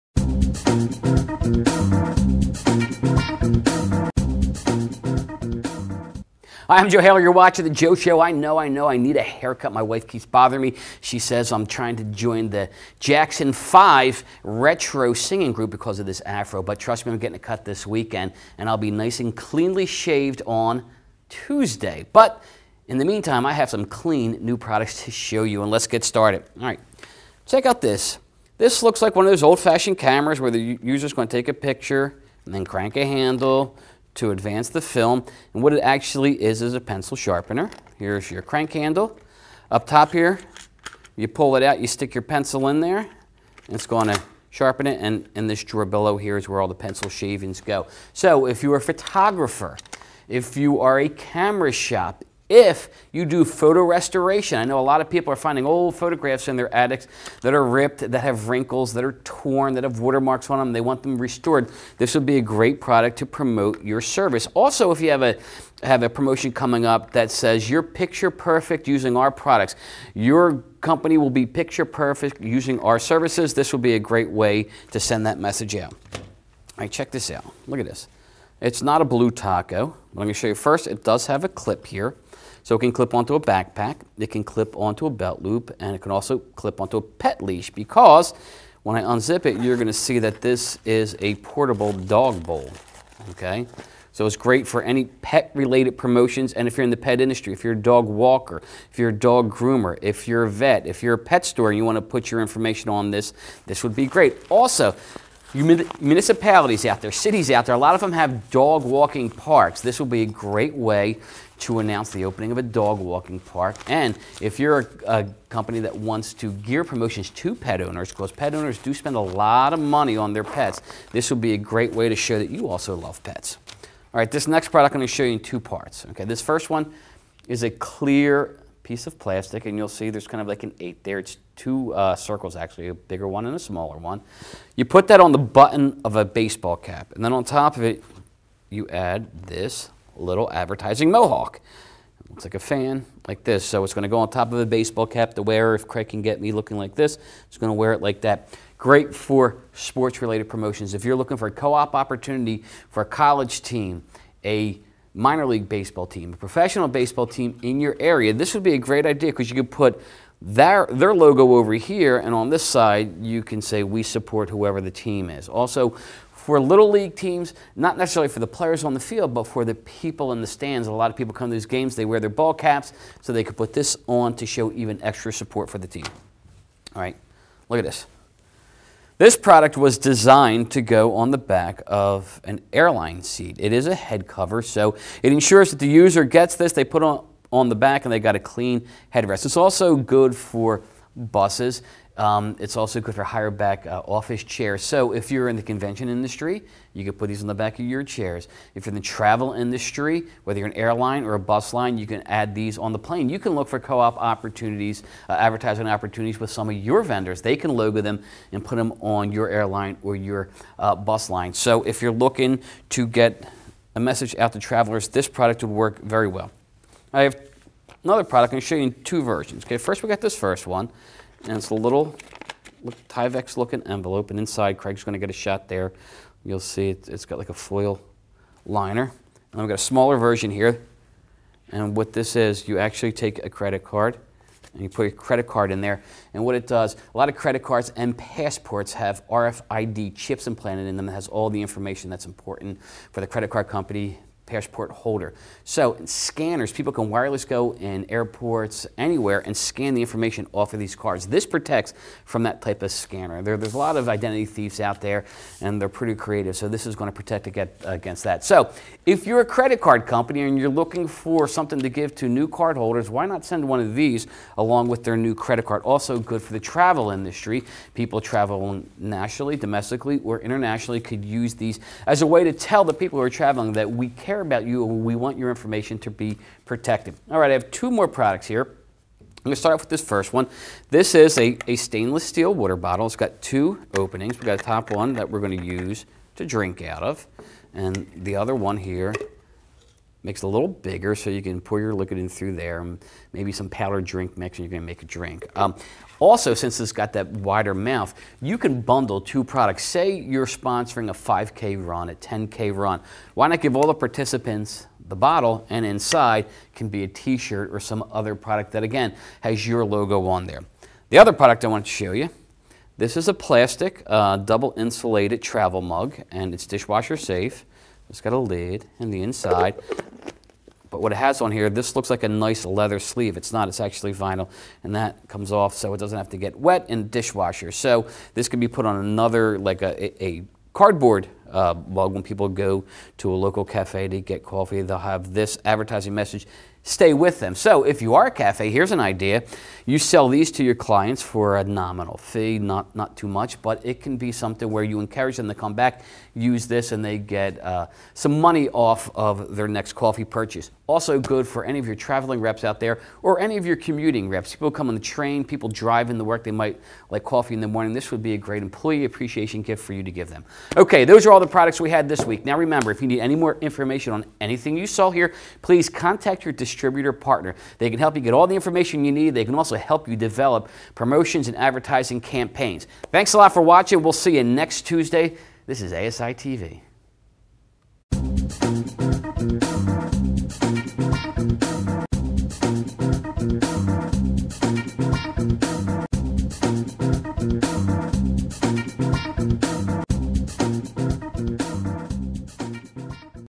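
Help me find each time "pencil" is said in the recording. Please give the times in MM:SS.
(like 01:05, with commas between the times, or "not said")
00:36, 00:42, 00:46.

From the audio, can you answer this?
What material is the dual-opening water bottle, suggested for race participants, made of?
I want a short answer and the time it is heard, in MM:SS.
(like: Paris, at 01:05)
stainless steel, at 04:41.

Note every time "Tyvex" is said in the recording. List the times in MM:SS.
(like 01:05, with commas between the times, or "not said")
03:43.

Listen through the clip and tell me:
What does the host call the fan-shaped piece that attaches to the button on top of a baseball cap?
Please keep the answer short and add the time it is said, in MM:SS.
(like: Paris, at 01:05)
advertising mohawk, at 02:20.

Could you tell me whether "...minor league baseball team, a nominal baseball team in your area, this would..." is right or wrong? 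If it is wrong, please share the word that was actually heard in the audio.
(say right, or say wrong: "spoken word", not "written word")
wrong: "professional", not "nominal".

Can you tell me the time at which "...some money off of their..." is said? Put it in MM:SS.
05:48.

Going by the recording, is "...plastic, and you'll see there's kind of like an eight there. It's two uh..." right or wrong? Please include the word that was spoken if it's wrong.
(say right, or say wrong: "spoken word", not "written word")
right.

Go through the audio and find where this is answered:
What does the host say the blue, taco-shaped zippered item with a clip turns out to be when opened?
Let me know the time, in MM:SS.
01:31.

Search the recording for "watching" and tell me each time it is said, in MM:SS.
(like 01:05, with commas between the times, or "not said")
00:07, 06:13.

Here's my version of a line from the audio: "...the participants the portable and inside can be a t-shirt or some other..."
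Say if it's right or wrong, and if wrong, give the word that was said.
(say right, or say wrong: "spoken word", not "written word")
wrong: "bottle", not "portable".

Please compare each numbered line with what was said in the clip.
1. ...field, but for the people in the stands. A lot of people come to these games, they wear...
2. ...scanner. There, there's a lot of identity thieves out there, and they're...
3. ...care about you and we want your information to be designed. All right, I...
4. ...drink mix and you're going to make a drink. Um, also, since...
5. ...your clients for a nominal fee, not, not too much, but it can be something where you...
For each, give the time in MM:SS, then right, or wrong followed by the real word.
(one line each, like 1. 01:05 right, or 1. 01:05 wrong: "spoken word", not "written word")
1. 02:48 right
2. 04:12 right
3. 04:34 wrong: "protected", not "designed"
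4. 04:54 right
5. 05:40 right.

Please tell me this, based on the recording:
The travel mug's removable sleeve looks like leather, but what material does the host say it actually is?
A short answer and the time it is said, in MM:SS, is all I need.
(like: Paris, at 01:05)
vinyl, at 05:24.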